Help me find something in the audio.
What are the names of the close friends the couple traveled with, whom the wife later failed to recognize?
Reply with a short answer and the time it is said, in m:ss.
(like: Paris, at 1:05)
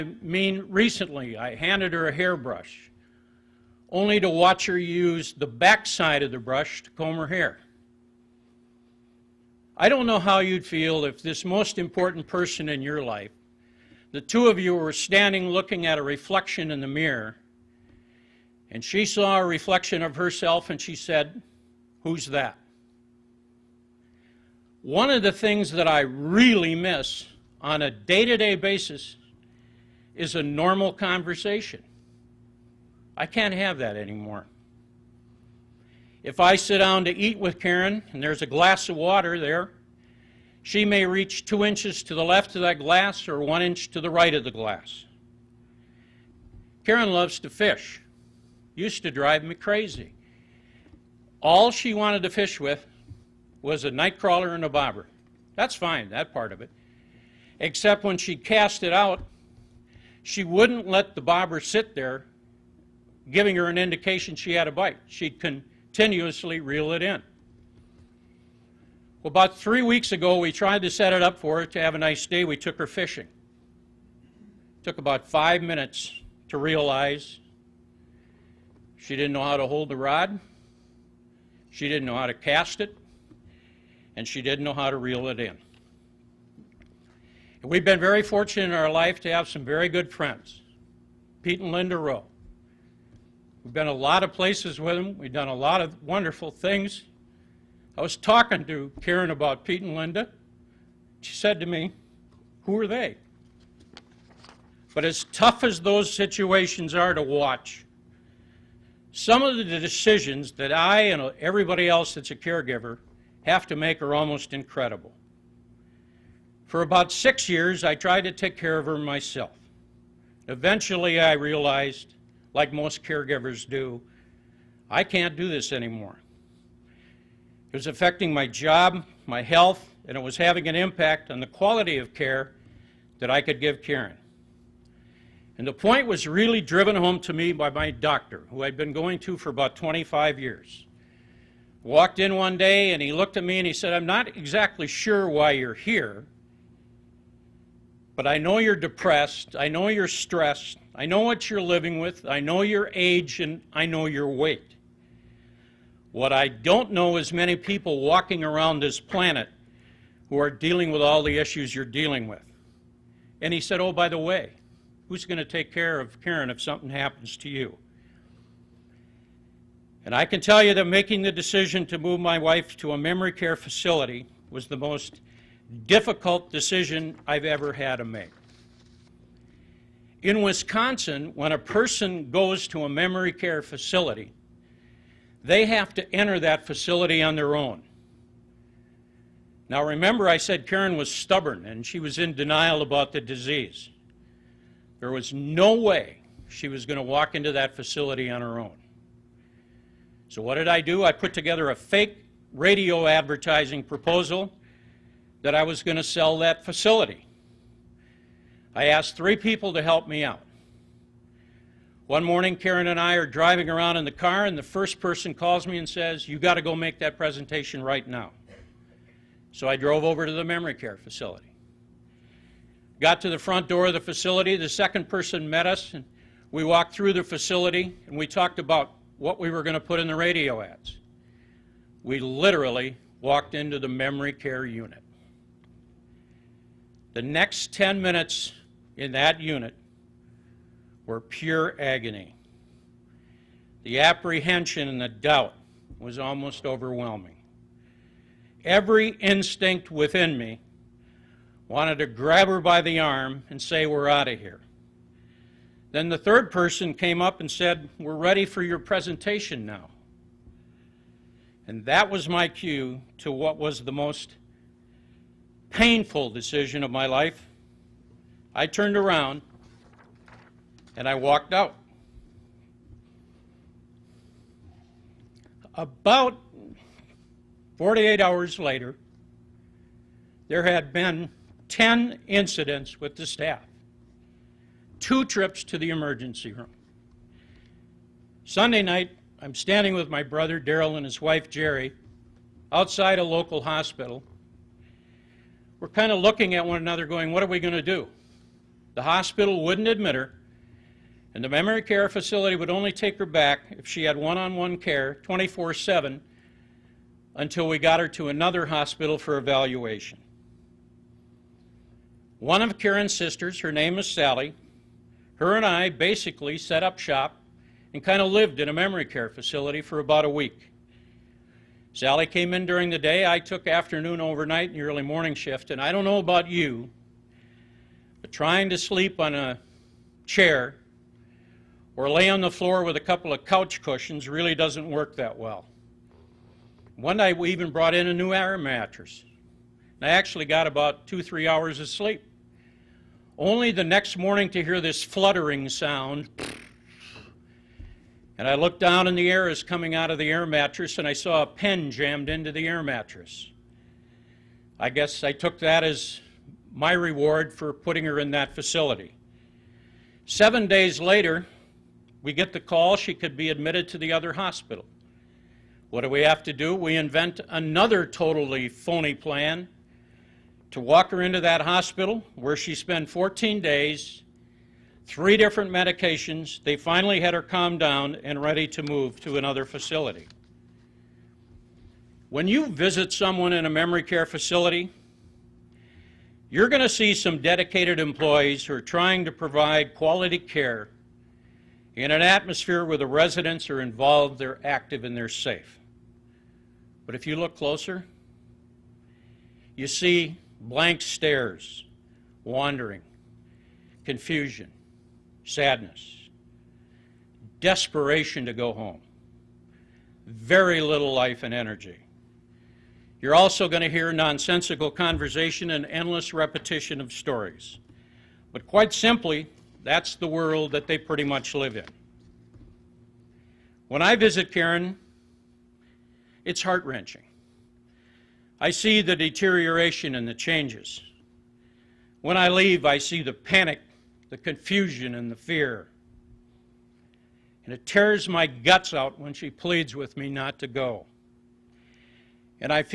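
Pete and Linda Rowe, at 1:31.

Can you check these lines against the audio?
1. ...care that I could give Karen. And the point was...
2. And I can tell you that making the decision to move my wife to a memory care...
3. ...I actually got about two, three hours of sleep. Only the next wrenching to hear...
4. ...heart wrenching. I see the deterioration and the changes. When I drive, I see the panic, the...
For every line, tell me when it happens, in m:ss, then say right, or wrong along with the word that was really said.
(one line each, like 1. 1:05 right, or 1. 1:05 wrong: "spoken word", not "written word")
1. 2:12 right
2. 2:50 right
3. 5:40 wrong: "morning", not "wrenching"
4. 7:06 wrong: "leave", not "drive".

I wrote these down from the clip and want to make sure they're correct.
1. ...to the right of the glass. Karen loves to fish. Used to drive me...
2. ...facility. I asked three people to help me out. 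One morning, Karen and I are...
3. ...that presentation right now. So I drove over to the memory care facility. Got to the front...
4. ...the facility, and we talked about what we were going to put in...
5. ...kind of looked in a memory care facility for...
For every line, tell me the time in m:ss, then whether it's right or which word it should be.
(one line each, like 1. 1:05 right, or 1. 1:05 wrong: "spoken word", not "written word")
1. 0:43 right
2. 3:26 right
3. 3:36 right
4. 3:47 right
5. 5:18 wrong: "lived", not "looked".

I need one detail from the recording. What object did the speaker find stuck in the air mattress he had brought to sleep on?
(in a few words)
pen.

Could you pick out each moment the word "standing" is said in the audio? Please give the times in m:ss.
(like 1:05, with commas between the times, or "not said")
0:14, 4:49.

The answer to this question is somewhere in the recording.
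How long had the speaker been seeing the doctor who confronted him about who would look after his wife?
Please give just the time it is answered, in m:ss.
2:19.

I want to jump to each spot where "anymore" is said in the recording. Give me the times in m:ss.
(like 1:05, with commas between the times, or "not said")
0:33, 2:05.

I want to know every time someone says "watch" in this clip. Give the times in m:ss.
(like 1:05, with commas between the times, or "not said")
0:04, 1:47.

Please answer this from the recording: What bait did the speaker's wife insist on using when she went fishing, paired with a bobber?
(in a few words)
nightcrawler.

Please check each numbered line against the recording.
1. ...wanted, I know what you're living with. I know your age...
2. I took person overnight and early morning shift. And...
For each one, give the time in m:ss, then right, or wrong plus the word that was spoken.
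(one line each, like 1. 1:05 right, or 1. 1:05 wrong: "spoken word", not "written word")
1. 2:30 wrong: "stressed", not "wanted"
2. 5:23 wrong: "afternoon", not "person".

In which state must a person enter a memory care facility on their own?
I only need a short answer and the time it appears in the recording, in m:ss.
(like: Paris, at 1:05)
Wisconsin, at 3:00.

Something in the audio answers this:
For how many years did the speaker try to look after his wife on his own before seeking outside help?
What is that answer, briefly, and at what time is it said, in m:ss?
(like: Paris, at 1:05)
6, at 1:57.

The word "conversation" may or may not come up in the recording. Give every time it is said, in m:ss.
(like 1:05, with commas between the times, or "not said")
0:30, 6:54.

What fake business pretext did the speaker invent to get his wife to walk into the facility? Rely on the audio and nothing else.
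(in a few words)
radio advertising proposal.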